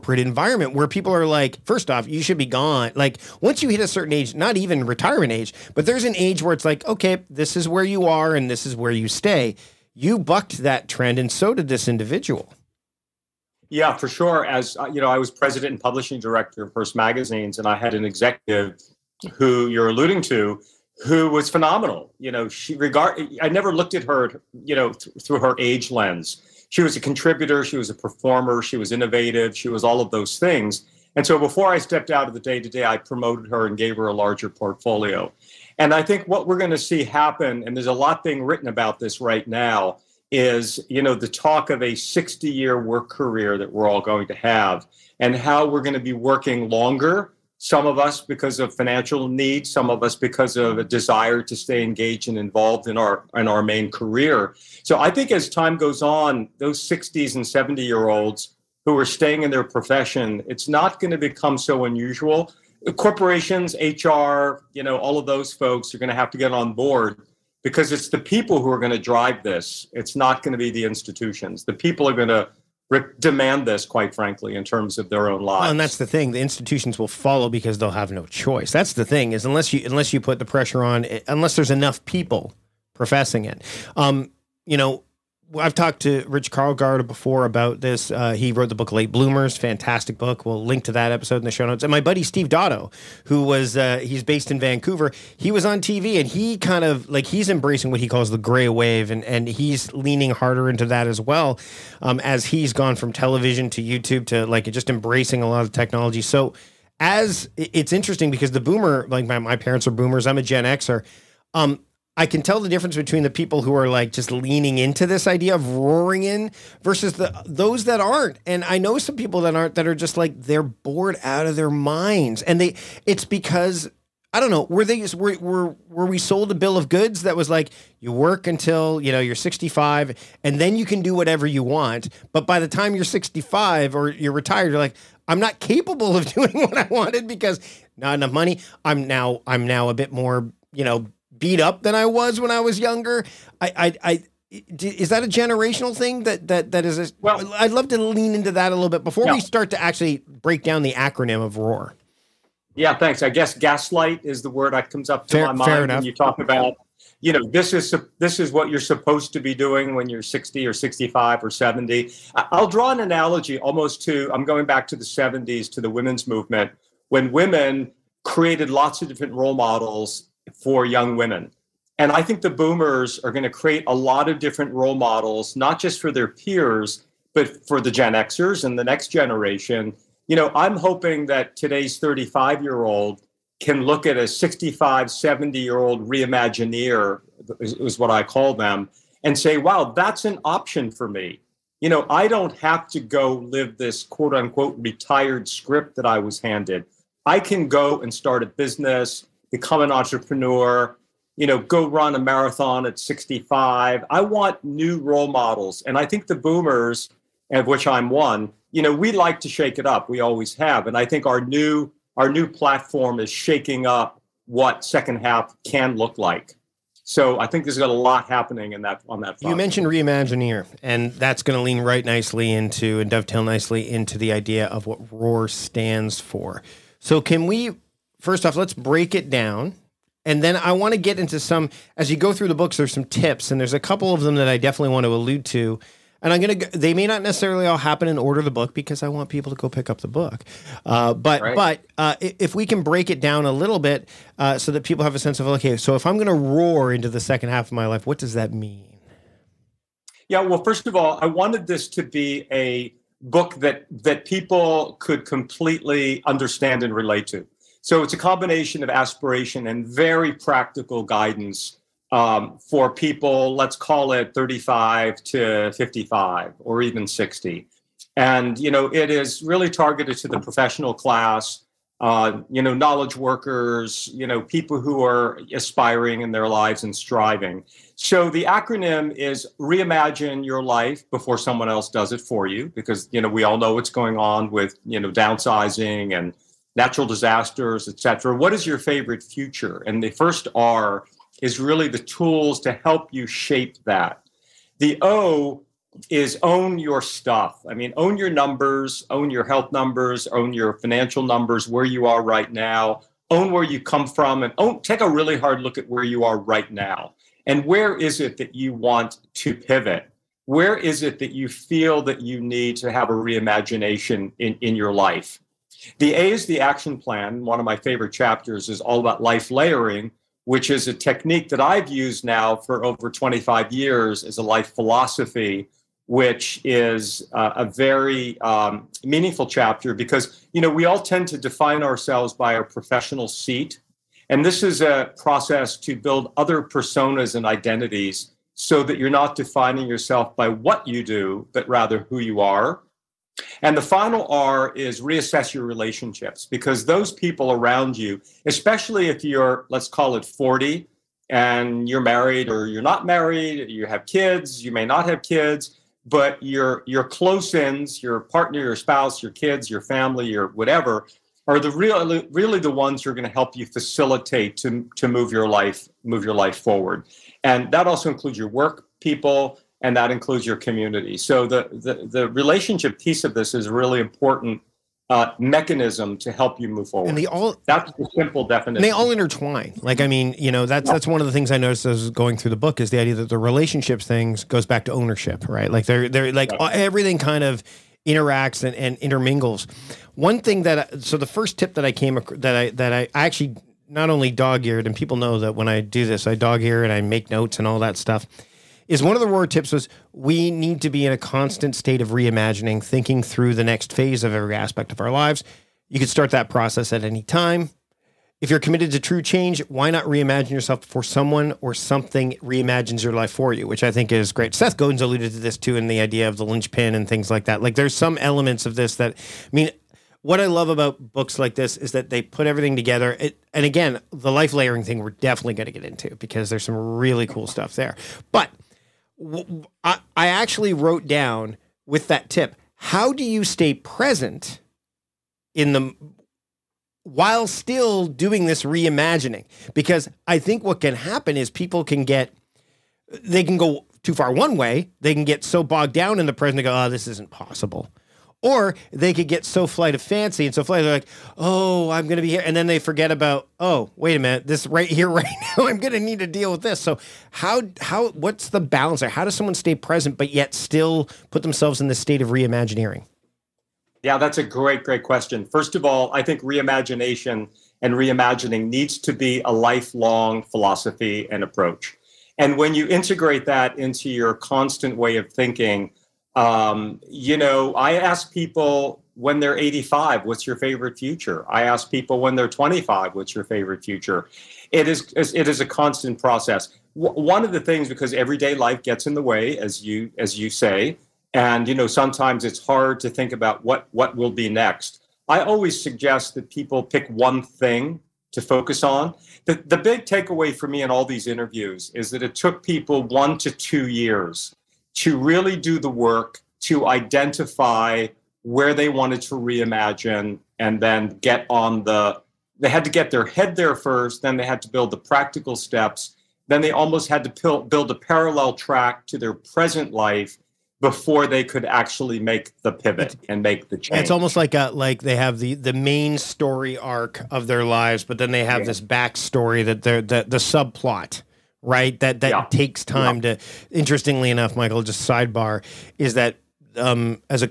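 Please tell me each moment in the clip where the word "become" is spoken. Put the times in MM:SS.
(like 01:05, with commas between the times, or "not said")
01:01, 03:19.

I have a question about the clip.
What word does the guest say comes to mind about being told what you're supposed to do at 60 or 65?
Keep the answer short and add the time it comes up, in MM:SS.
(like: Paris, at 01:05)
gaslight, at 02:33.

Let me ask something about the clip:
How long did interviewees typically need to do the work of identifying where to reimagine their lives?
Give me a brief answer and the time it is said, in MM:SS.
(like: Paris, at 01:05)
1 to 2 years, at 08:23.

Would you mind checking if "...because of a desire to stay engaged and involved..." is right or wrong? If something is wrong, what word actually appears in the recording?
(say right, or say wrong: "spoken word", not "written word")
right.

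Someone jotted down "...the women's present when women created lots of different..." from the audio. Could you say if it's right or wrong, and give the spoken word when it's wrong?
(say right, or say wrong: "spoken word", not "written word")
wrong: "movement", not "present".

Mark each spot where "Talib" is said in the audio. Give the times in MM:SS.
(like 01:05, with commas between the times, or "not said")
not said.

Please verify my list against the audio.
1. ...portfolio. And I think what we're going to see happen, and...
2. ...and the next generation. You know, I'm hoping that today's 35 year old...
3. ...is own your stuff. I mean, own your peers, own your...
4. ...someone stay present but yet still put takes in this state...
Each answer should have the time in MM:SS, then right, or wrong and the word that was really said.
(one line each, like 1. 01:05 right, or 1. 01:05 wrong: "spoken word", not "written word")
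1. 00:34 right
2. 02:58 right
3. 04:56 wrong: "numbers", not "peers"
4. 07:39 wrong: "themselves", not "takes".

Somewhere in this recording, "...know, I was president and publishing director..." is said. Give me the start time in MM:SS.
00:14.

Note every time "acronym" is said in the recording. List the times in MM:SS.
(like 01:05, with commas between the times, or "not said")
02:30, 04:38.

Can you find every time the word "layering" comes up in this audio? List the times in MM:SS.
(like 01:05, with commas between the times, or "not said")
05:19, 07:04.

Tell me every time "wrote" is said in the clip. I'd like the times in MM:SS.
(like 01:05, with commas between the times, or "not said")
01:28, 07:10.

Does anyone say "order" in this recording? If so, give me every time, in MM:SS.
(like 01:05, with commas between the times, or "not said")
03:58.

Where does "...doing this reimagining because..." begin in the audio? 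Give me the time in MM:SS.
07:18.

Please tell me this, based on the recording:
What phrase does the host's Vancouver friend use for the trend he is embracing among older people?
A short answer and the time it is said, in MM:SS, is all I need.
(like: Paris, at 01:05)
gray wave, at 01:38.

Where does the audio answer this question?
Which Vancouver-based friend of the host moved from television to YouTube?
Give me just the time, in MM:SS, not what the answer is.
01:32.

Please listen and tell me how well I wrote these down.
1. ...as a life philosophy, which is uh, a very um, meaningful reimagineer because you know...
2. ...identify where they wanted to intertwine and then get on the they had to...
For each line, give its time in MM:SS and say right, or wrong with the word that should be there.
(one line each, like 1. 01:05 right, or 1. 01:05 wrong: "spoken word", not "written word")
1. 05:24 wrong: "chapter", not "reimagineer"
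2. 08:26 wrong: "reimagine", not "intertwine".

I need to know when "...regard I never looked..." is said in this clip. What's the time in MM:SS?
00:22.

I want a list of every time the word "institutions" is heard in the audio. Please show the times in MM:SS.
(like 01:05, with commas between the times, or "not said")
01:10, 01:16.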